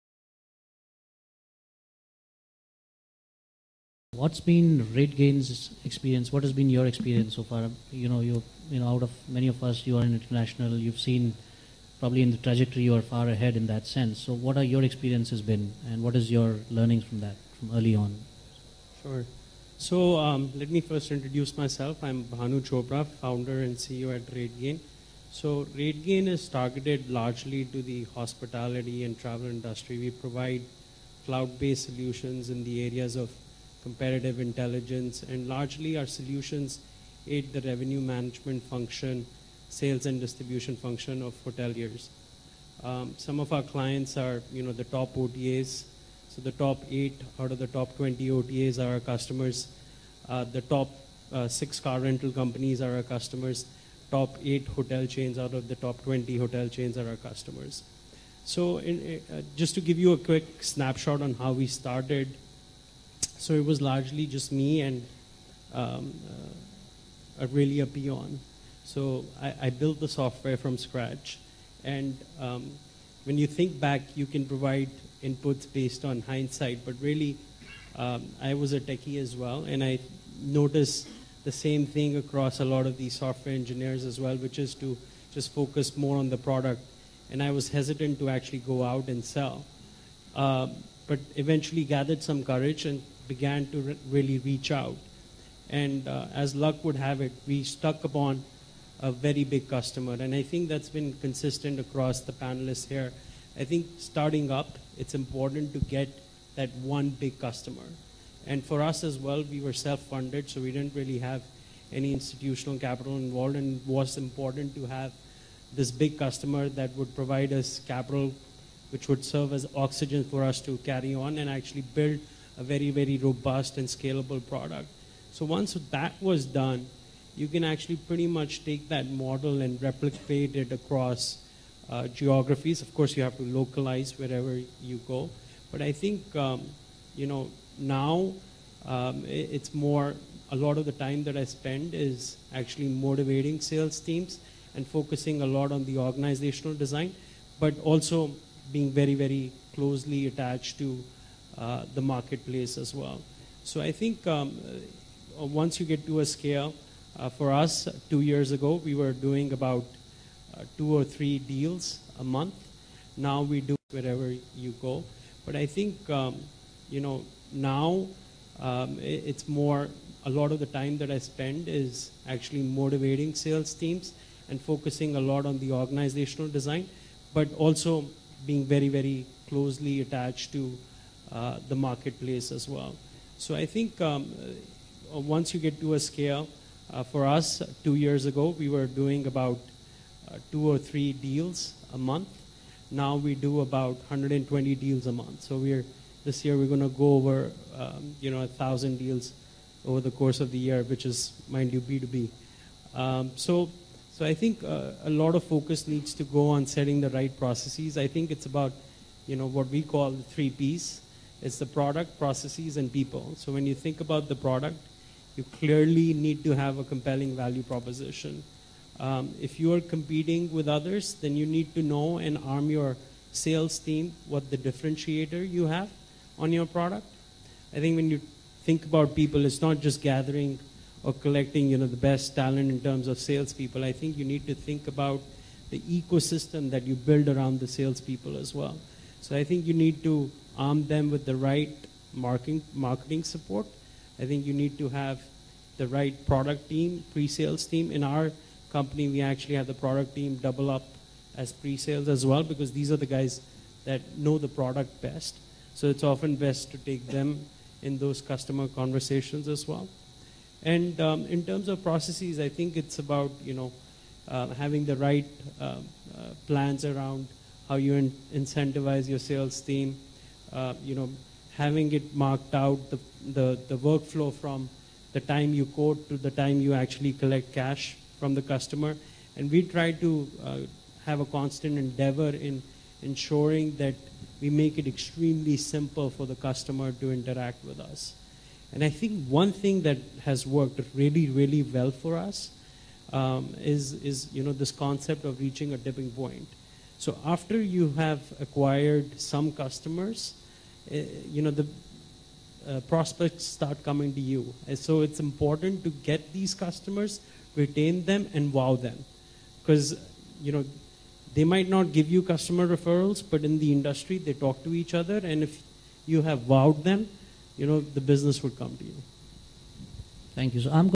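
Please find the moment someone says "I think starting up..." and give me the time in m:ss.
1:43.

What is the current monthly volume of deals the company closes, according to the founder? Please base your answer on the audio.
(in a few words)
120.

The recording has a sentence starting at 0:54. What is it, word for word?
Top eight hotel chains out of the top 20 hotel chains are our customers.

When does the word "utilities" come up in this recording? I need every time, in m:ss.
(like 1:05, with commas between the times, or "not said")
not said.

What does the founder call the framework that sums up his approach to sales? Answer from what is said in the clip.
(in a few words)
the three P's.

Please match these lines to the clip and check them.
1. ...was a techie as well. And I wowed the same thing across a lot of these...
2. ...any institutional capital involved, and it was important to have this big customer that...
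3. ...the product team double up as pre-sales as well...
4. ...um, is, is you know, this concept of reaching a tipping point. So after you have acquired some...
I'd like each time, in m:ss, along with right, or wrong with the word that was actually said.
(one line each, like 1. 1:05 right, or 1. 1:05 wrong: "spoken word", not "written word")
1. 1:18 wrong: "noticed", not "wowed"
2. 1:51 right
3. 4:09 right
4. 4:53 right.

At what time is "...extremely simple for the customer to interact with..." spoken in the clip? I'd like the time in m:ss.
4:44.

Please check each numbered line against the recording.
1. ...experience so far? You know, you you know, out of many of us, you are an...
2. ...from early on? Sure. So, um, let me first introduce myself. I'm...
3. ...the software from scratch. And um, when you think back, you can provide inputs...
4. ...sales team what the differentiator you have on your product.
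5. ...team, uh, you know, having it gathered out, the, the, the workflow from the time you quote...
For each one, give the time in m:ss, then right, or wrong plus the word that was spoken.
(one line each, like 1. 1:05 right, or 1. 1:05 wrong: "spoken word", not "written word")
1. 0:06 right
2. 0:17 right
3. 1:09 right
4. 3:43 right
5. 4:29 wrong: "marked", not "gathered".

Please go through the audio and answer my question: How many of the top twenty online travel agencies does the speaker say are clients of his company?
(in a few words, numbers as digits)
8.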